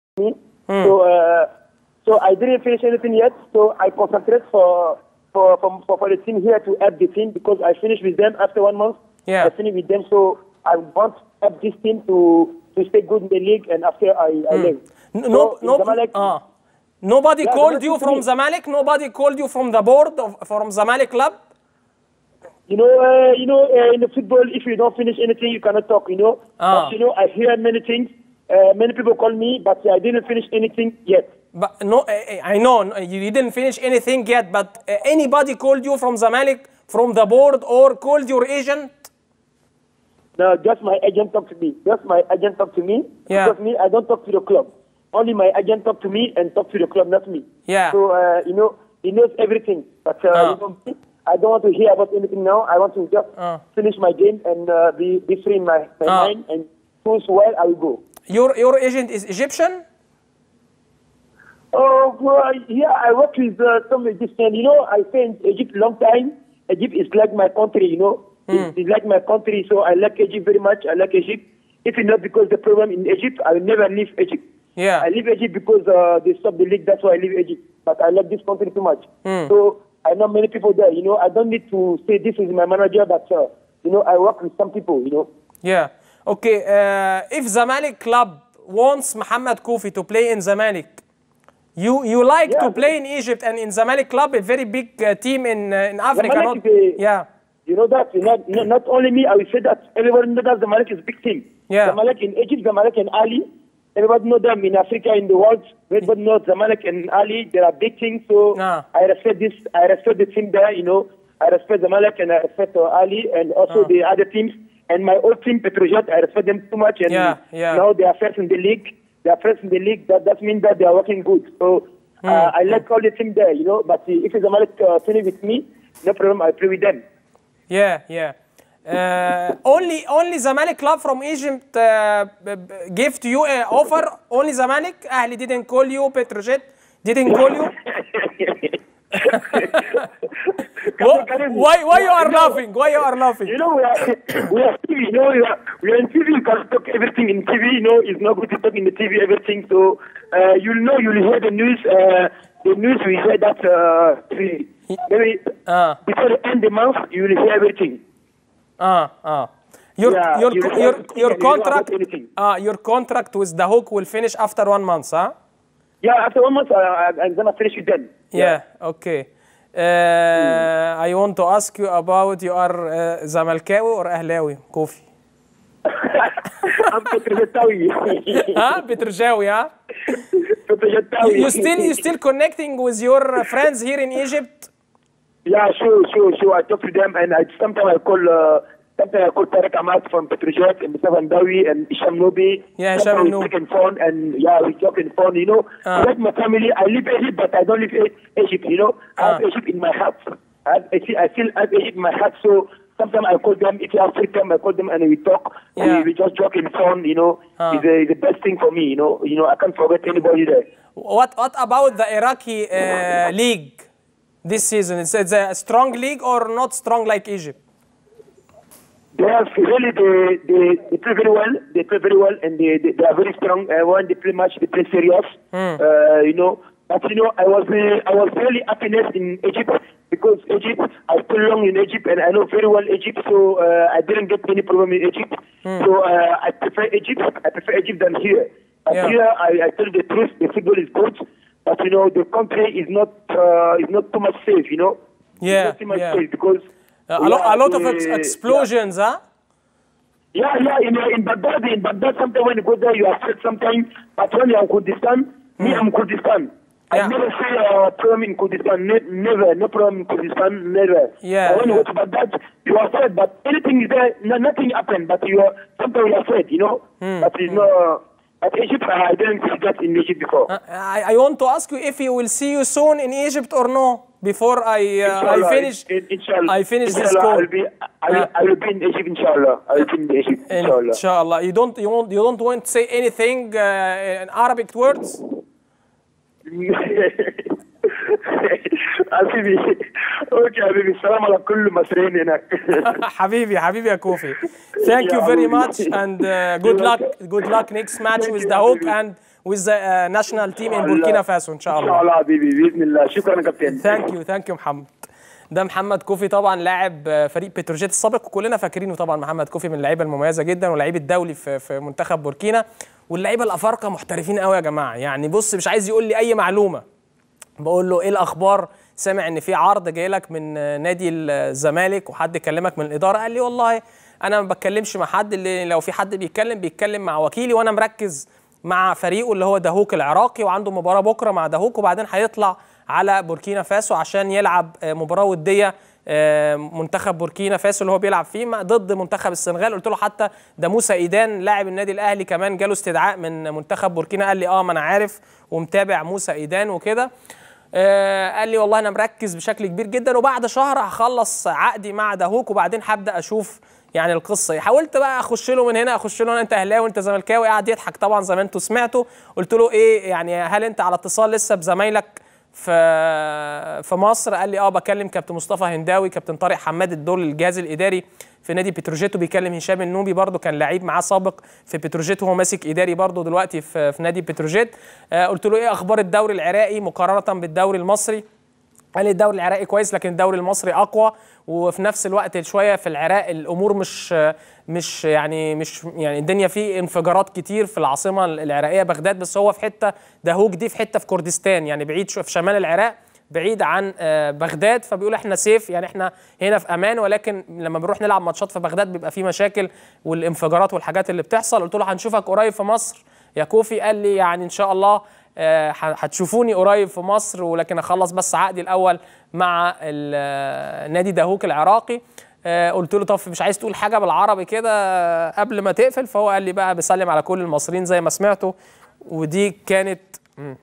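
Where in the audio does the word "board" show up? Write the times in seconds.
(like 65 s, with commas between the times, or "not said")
19 s, 37 s.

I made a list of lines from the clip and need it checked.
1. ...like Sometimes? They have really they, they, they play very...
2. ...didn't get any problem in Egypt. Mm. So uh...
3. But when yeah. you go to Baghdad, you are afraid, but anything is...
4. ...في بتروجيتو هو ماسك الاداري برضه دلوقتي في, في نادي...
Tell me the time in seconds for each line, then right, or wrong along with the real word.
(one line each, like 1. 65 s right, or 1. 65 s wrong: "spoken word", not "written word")
1. 217 s wrong: "Egypt", not "Sometimes"
2. 234 s right
3. 261 s right
4. 371 s wrong: "اداري", not "الاداري".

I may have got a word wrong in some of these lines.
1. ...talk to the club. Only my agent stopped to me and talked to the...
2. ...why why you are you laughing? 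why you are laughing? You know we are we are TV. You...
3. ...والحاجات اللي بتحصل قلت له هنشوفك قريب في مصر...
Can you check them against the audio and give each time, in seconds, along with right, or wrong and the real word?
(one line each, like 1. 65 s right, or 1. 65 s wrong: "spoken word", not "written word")
1. 44 s wrong: "talked", not "stopped"
2. 140 s right
3. 400 s right.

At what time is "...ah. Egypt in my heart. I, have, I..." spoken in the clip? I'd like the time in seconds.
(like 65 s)
199 s.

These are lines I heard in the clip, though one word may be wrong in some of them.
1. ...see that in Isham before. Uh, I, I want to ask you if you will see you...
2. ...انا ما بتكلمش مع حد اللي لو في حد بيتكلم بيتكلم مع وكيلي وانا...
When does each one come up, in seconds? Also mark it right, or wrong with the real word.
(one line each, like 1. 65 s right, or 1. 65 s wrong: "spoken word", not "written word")
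1. 269 s wrong: "Egypt", not "Isham"
2. 324 s right.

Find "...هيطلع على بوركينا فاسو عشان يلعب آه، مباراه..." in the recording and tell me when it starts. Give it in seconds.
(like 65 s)
332 s.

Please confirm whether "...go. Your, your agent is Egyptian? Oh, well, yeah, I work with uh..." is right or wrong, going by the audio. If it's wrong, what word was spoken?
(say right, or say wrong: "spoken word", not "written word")
right.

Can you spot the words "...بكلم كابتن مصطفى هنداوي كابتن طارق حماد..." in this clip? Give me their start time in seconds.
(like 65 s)
364 s.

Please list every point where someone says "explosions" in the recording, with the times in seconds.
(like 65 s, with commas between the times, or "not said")
248 s.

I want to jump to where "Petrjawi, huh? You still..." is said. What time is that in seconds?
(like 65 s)
178 s.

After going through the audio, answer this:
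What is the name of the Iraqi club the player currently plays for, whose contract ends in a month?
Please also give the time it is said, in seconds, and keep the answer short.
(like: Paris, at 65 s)
Duhok, at 163 s.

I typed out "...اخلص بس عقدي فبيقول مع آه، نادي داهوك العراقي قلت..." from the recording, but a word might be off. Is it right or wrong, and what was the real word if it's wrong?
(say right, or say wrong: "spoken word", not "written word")
wrong: "الاول", not "فبيقول".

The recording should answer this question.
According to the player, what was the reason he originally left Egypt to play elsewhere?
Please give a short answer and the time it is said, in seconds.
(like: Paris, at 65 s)
They stopped the league, at 76 s.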